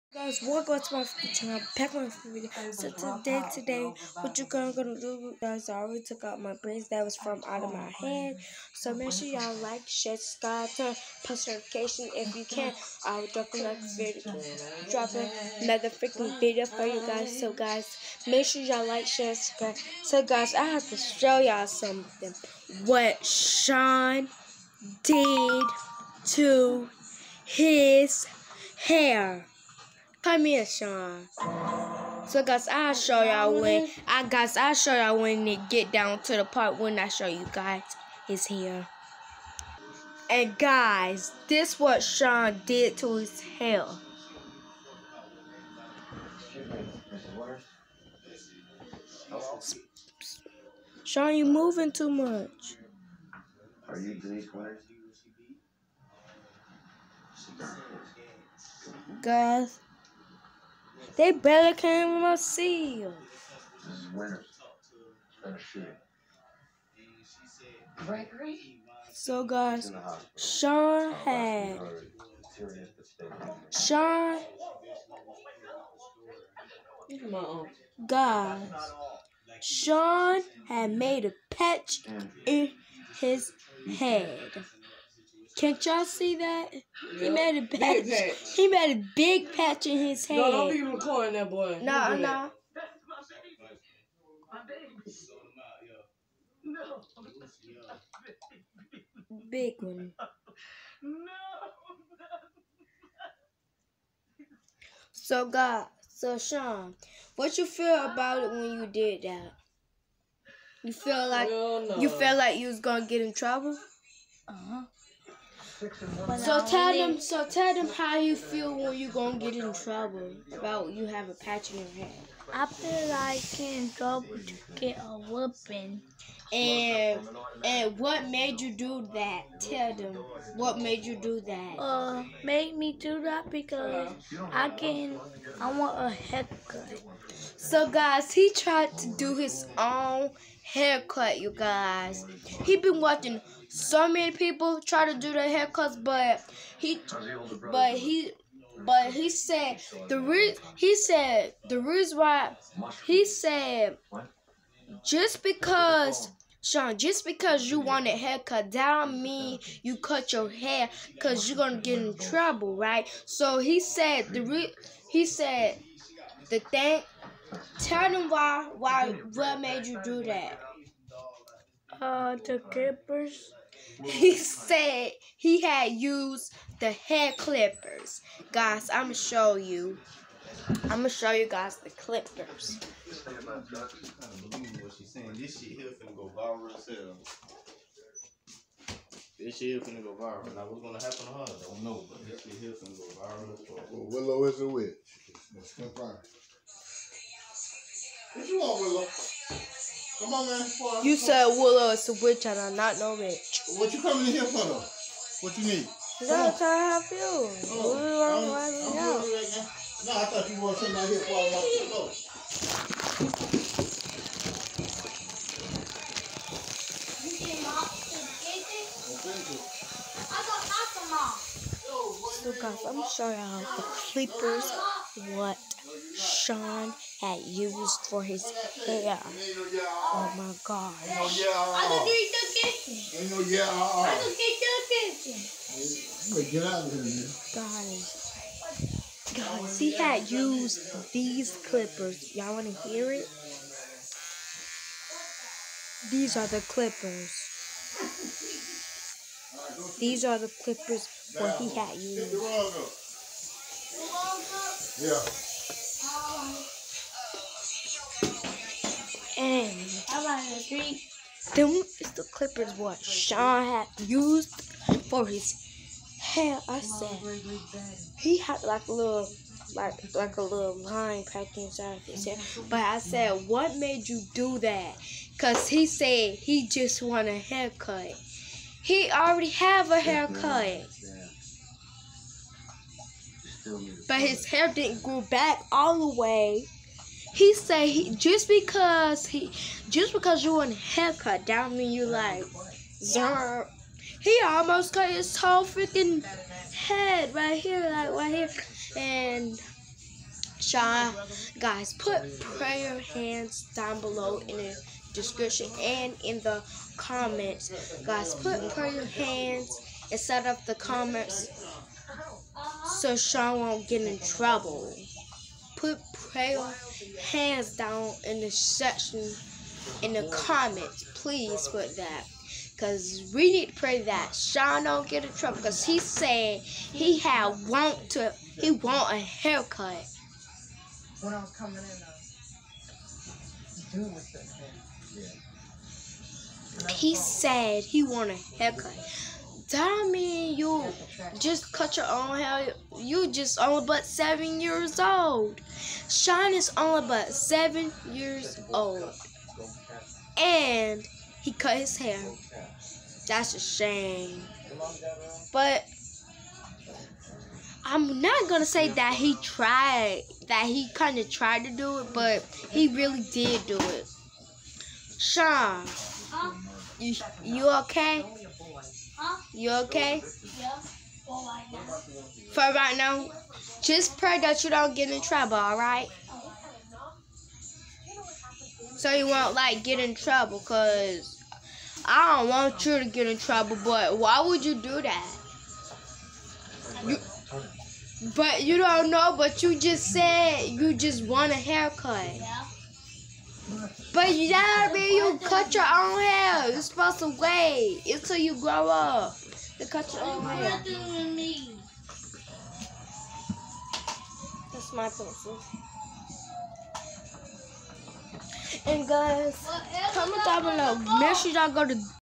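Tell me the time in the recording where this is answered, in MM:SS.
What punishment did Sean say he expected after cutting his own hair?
02:04.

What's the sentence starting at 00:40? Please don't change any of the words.
And guys, this what Sean did to his hair.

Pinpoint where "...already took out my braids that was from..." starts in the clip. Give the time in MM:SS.
00:05.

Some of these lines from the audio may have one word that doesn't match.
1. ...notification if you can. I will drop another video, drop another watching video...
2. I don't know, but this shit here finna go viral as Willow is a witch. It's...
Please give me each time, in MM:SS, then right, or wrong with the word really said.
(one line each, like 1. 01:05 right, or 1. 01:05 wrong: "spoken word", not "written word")
1. 00:11 wrong: "freaking", not "watching"
2. 03:11 right.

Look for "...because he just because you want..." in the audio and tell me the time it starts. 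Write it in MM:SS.
04:48.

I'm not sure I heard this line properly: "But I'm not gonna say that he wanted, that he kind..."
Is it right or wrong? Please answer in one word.
wrong.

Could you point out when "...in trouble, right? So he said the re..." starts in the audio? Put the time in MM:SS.
02:41.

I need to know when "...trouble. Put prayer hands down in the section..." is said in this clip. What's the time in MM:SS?
05:14.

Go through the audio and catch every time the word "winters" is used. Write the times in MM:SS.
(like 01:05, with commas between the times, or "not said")
00:54, 01:04.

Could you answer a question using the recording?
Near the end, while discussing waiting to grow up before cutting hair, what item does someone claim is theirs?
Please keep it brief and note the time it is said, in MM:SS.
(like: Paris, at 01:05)
Pencil, at 06:45.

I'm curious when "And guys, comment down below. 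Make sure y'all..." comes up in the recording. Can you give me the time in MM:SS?
06:48.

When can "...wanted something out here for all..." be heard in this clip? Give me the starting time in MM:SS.
03:30.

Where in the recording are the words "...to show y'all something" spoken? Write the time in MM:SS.
00:20.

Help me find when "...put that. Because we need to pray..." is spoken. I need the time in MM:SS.
05:21.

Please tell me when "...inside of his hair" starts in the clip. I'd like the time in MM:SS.
04:31.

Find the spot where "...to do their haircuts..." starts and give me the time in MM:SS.
02:25.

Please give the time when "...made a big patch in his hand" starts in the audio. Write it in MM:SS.
01:28.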